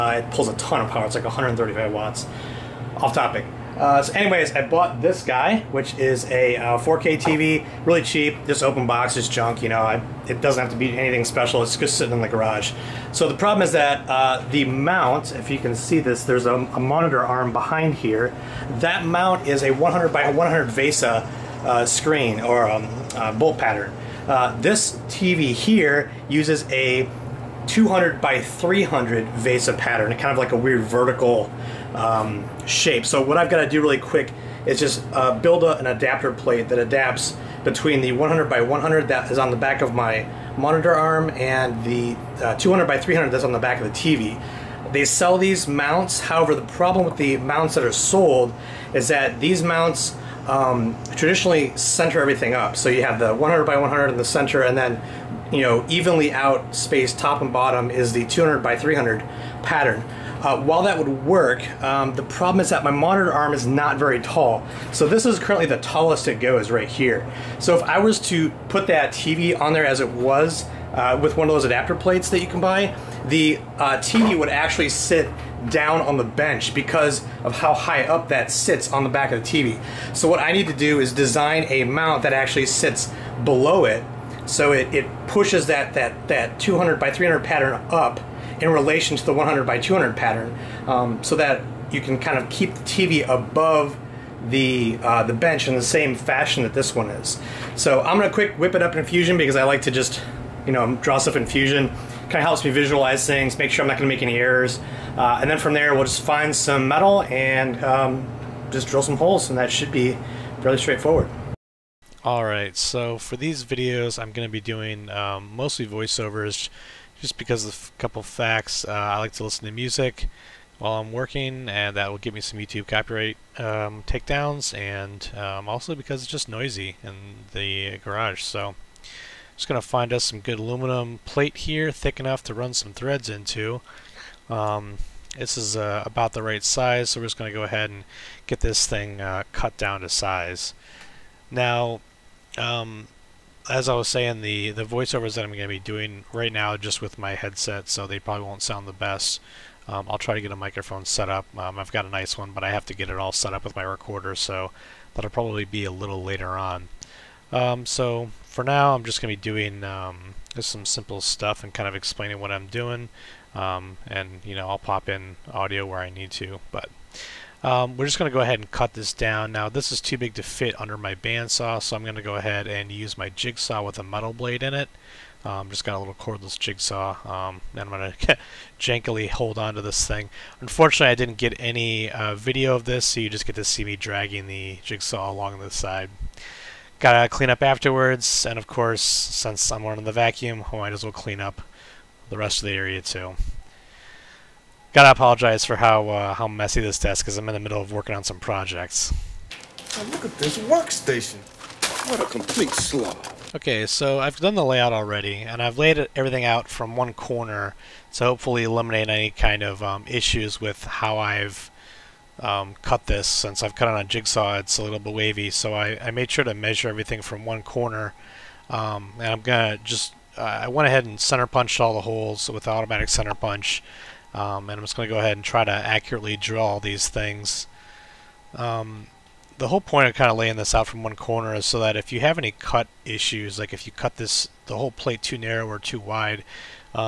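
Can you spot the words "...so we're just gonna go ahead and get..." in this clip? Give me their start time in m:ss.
2:17.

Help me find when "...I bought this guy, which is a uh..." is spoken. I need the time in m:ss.
0:04.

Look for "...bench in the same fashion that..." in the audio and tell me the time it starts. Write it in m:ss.
1:35.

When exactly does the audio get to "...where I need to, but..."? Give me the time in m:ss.
2:45.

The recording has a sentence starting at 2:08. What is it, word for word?
So, just gonna find us some good aluminum plate here, thick enough to run some threads into.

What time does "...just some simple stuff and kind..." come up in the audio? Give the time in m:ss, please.
2:40.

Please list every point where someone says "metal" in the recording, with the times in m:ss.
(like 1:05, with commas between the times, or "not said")
1:46, 2:54.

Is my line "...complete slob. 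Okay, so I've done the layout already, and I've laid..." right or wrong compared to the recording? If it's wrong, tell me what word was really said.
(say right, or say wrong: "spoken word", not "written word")
right.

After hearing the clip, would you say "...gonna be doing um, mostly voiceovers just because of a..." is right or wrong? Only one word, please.
right.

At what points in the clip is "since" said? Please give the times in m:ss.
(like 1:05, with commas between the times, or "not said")
3:09, 3:33.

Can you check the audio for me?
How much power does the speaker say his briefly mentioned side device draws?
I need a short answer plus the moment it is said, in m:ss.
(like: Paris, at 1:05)
135 watts, at 0:01.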